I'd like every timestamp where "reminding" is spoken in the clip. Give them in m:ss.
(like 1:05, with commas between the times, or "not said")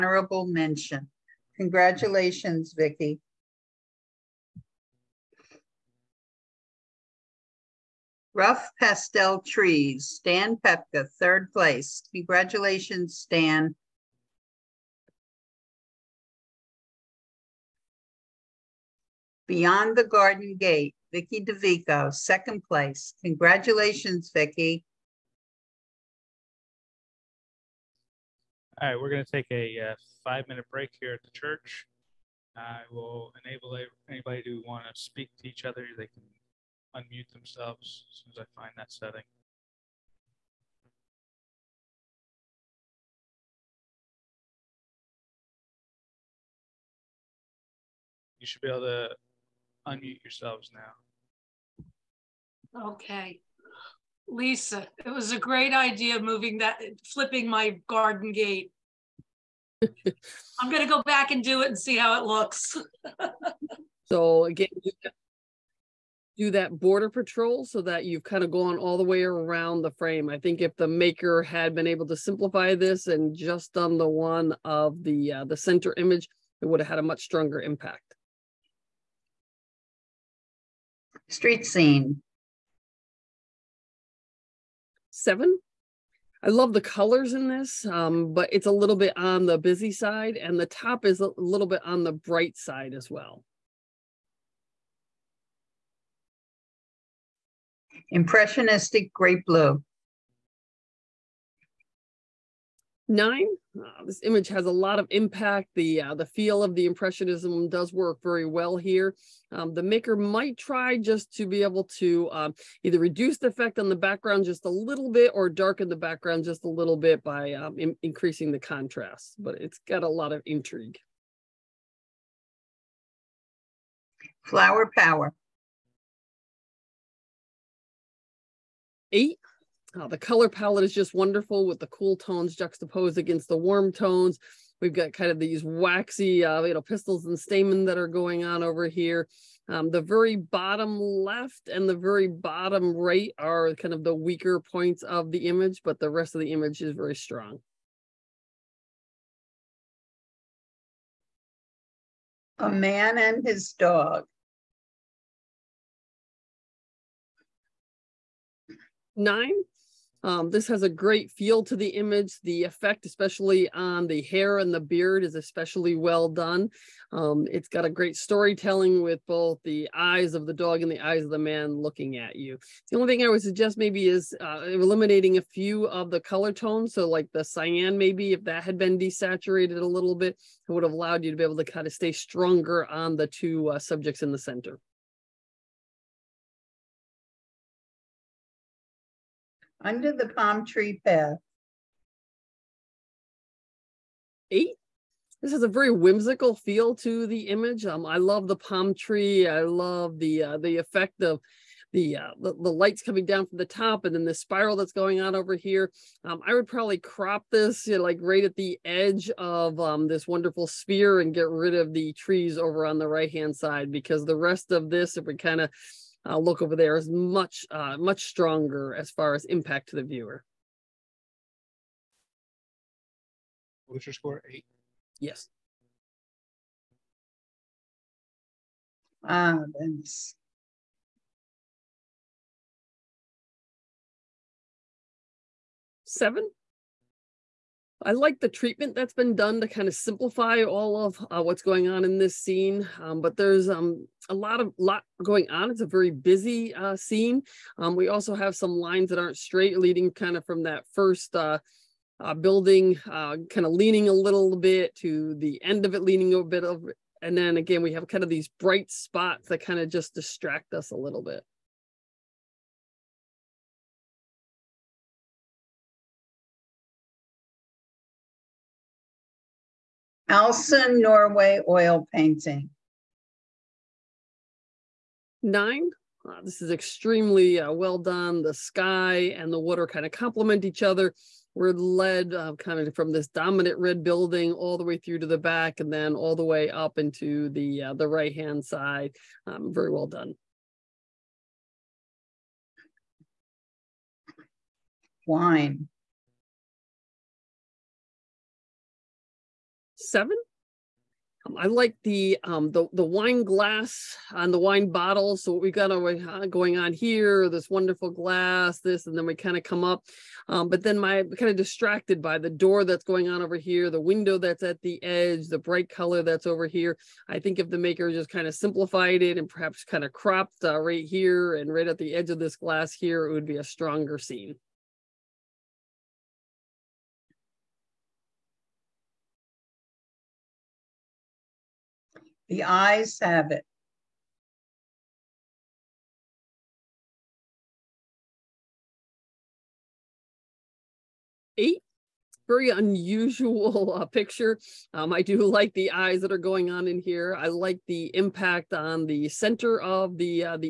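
not said.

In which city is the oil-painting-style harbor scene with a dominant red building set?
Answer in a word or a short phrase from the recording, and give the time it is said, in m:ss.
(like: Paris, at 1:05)
Alesund, Norway, at 4:30.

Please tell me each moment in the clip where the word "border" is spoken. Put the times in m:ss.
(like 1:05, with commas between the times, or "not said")
1:06.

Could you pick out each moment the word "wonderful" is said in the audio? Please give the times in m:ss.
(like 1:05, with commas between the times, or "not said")
2:11, 3:30, 5:07.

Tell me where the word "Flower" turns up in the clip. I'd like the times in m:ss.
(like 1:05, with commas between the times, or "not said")
2:04.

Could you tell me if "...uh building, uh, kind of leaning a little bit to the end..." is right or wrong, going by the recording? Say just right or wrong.
right.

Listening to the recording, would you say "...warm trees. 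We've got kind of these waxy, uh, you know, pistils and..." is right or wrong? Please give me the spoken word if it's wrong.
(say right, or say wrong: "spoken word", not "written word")
wrong: "tones", not "trees".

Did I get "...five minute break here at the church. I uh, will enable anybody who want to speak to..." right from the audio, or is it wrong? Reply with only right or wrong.
right.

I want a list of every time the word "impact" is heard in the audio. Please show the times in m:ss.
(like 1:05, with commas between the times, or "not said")
1:17, 1:45, 3:39, 5:48.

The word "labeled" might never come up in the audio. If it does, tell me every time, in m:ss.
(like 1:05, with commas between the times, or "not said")
not said.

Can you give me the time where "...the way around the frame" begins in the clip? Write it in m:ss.
1:08.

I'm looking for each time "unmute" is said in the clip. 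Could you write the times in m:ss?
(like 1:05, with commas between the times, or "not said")
0:36, 0:49.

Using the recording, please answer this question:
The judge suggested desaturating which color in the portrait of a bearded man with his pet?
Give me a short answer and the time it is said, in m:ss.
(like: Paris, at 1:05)
cyan, at 2:57.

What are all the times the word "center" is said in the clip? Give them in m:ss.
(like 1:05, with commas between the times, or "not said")
1:15, 3:04, 5:49.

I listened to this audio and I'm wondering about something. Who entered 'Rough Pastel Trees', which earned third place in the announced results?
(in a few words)
Stan Pepka.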